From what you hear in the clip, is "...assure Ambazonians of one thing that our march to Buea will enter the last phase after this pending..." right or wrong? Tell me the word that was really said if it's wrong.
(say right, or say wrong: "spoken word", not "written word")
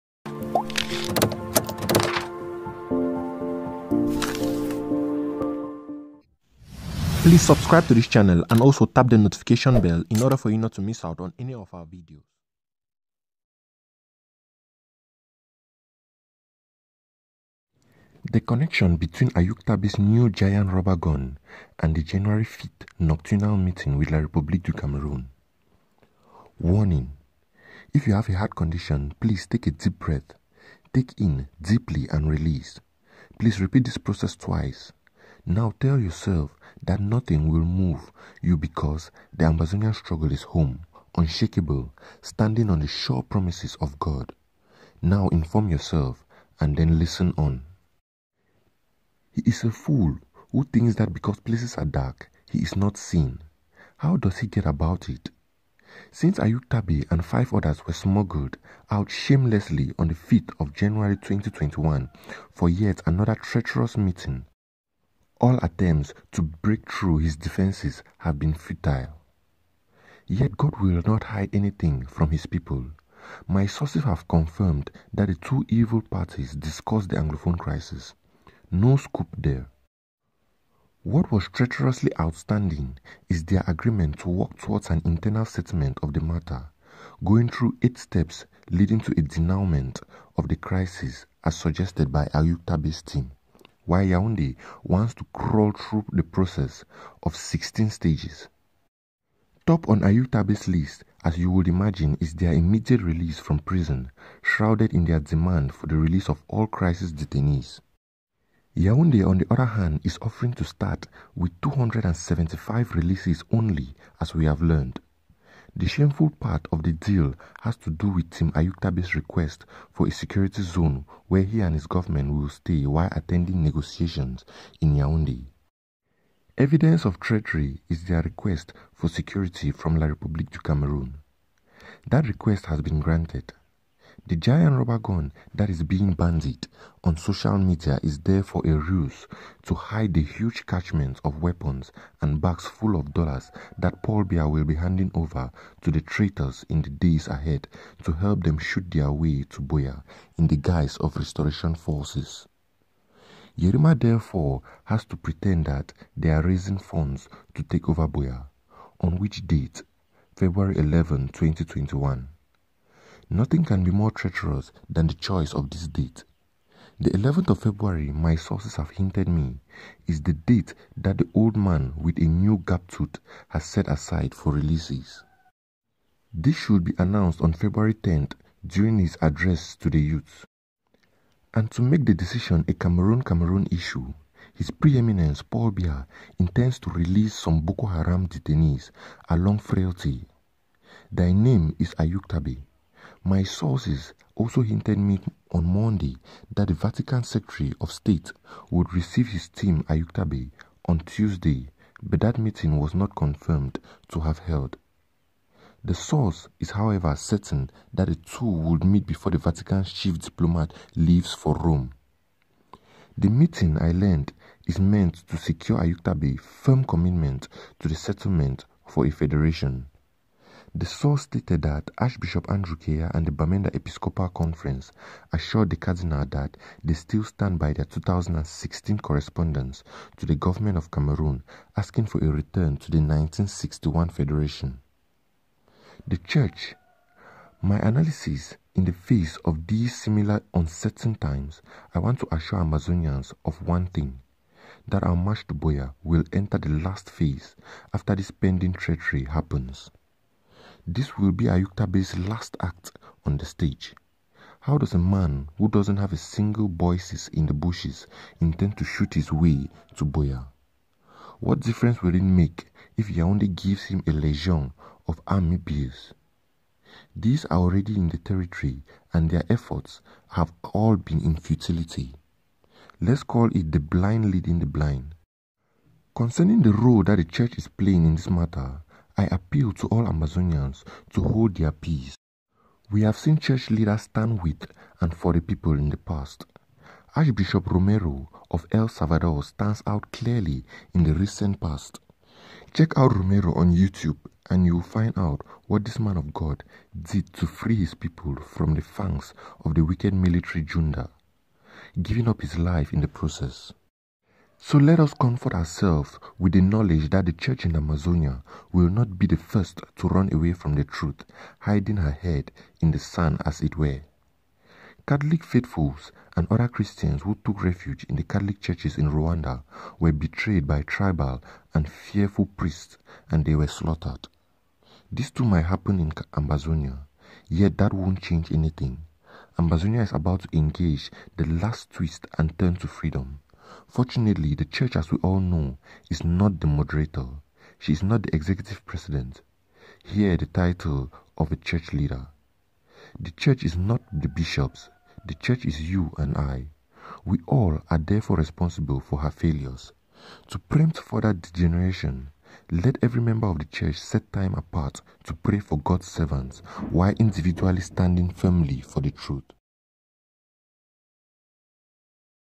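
right.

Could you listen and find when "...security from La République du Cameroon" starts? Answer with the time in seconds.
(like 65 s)
129 s.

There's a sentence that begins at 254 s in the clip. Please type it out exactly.
How does a man who doesn't have a single boyces in the bushes intend to shoot his way to Buea?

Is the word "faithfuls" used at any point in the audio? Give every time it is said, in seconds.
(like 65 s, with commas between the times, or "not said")
315 s.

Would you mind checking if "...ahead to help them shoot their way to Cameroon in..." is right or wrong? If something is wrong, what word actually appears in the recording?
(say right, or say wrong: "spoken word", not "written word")
wrong: "Buea", not "Cameroon".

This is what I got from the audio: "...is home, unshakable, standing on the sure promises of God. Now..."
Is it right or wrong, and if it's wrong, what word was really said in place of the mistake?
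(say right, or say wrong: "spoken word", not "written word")
right.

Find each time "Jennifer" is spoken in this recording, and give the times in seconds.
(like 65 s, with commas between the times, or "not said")
not said.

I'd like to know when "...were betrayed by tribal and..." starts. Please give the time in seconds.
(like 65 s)
319 s.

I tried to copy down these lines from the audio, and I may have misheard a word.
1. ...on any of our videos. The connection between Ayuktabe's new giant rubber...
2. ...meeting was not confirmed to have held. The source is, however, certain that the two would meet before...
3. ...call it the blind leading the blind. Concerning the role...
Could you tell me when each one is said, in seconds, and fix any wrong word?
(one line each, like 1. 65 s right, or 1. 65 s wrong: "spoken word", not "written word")
1. 11 s right
2. 202 s right
3. 273 s right.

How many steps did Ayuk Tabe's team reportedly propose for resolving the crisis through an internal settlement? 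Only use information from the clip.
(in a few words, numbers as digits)
8.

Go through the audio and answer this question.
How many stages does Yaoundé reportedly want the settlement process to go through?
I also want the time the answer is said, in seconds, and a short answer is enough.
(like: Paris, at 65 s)
16, at 97 s.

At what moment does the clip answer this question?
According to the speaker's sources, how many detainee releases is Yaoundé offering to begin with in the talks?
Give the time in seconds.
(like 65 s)
111 s.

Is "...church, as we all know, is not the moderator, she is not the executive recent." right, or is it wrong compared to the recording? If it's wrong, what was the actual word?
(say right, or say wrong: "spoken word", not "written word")
wrong: "president", not "recent".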